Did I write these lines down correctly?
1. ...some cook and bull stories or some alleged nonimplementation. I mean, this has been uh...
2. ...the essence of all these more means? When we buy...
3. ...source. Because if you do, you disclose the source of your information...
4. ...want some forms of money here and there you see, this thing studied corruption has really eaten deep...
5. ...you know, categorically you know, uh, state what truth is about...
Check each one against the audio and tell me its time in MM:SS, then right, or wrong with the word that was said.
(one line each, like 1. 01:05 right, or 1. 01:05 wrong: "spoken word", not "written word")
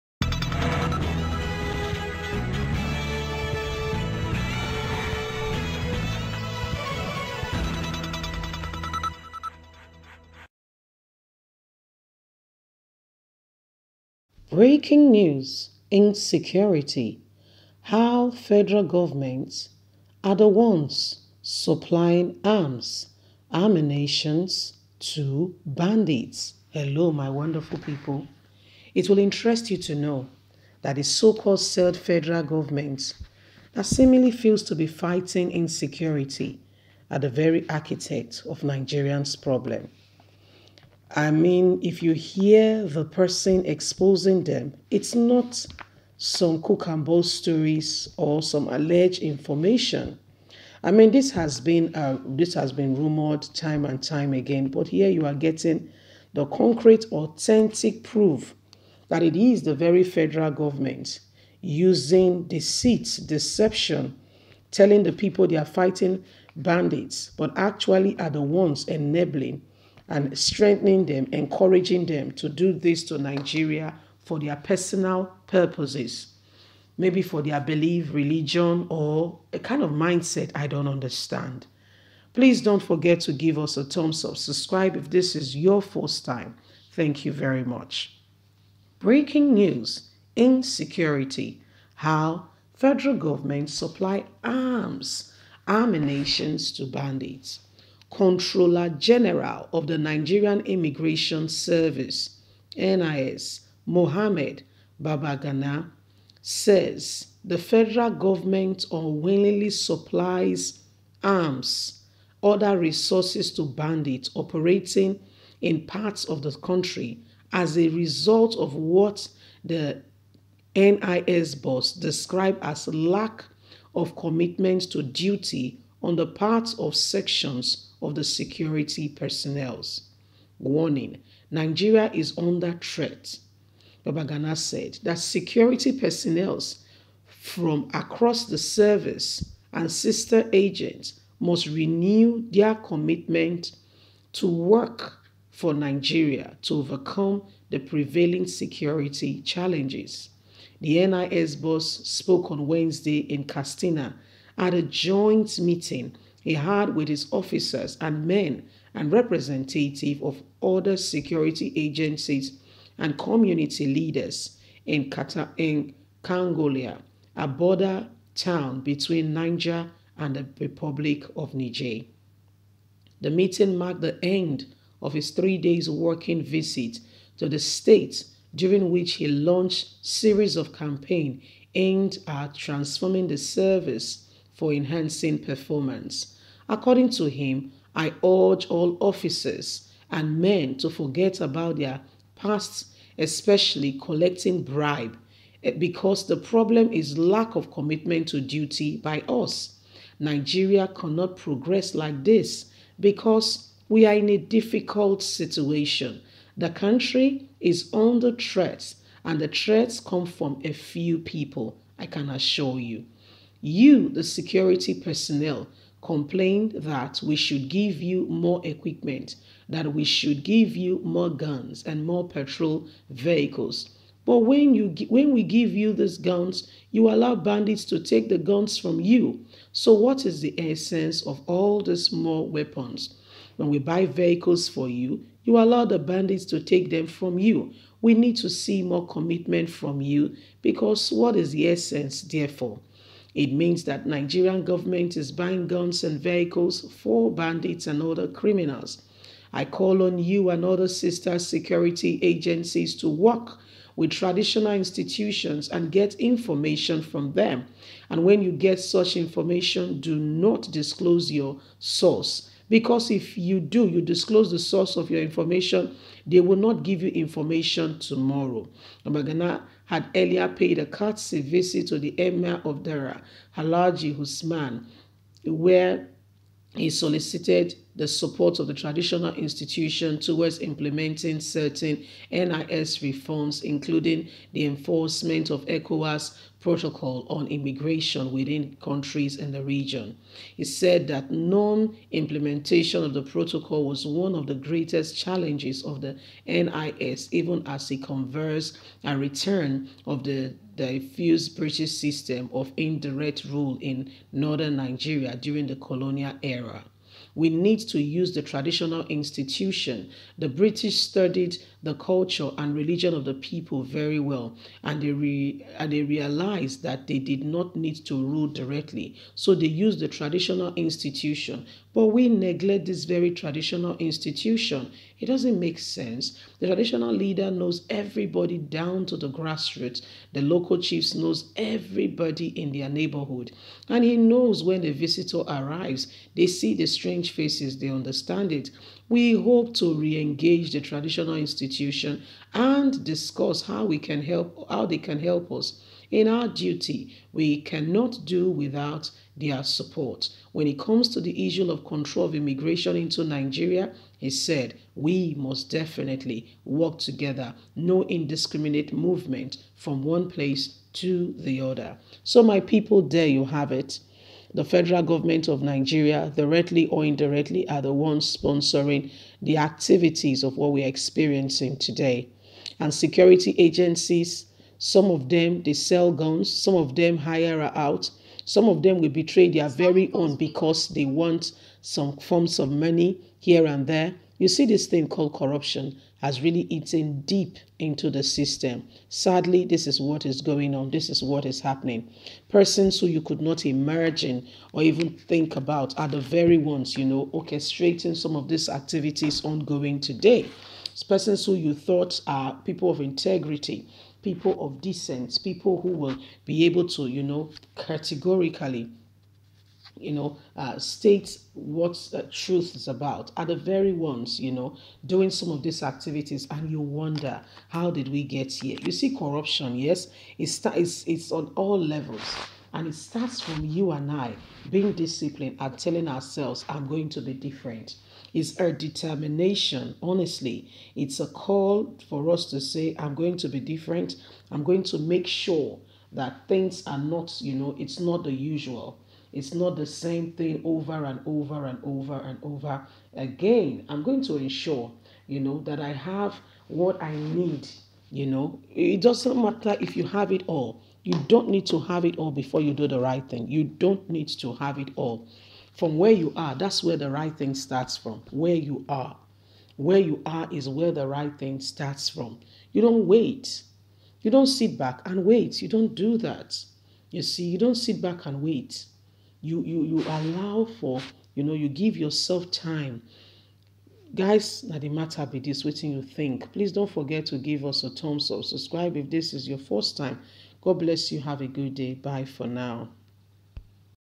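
1. 00:46 wrong: "information", not "nonimplementation"
2. 03:50 wrong: "weapons", not "means"
3. 04:21 right
4. 06:21 wrong: "called", not "studied"
5. 06:47 right.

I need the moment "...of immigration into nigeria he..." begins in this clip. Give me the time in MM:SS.
05:52.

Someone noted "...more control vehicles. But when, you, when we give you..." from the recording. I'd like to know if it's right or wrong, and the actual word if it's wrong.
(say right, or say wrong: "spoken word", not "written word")
wrong: "patrol", not "control".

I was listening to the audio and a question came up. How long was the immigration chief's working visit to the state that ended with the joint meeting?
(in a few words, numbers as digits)
Three days.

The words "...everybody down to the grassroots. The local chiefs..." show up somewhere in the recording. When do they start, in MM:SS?
05:27.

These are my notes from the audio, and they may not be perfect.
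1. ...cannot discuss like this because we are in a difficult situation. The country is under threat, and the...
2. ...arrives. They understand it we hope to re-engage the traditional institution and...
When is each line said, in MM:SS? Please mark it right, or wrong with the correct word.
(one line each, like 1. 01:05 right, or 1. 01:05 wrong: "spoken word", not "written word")
1. 03:20 wrong: "progress", not "discuss"
2. 05:37 wrong: "faces", not "arrives".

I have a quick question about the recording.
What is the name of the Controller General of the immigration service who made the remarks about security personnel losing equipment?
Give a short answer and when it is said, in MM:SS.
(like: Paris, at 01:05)
Mohammed Babandede, at 01:43.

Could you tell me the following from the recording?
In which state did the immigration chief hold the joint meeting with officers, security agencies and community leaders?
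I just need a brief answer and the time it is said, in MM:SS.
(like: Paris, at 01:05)
Katsina, at 02:33.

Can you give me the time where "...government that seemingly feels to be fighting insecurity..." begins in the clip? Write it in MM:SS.
00:32.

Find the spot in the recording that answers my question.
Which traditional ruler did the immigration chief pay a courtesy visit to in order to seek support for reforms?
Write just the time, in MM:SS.
04:32.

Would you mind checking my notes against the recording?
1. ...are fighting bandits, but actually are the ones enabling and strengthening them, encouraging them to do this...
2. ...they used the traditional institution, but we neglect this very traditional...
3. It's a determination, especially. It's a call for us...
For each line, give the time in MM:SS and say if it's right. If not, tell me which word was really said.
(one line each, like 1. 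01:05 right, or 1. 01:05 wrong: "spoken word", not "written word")
1. 01:05 right
2. 05:19 right
3. 07:08 wrong: "honestly", not "especially".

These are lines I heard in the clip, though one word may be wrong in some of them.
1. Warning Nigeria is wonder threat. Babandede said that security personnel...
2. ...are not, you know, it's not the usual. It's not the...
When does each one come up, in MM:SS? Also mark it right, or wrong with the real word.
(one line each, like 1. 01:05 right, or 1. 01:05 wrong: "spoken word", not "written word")
1. 02:10 wrong: "under", not "wonder"
2. 07:16 right.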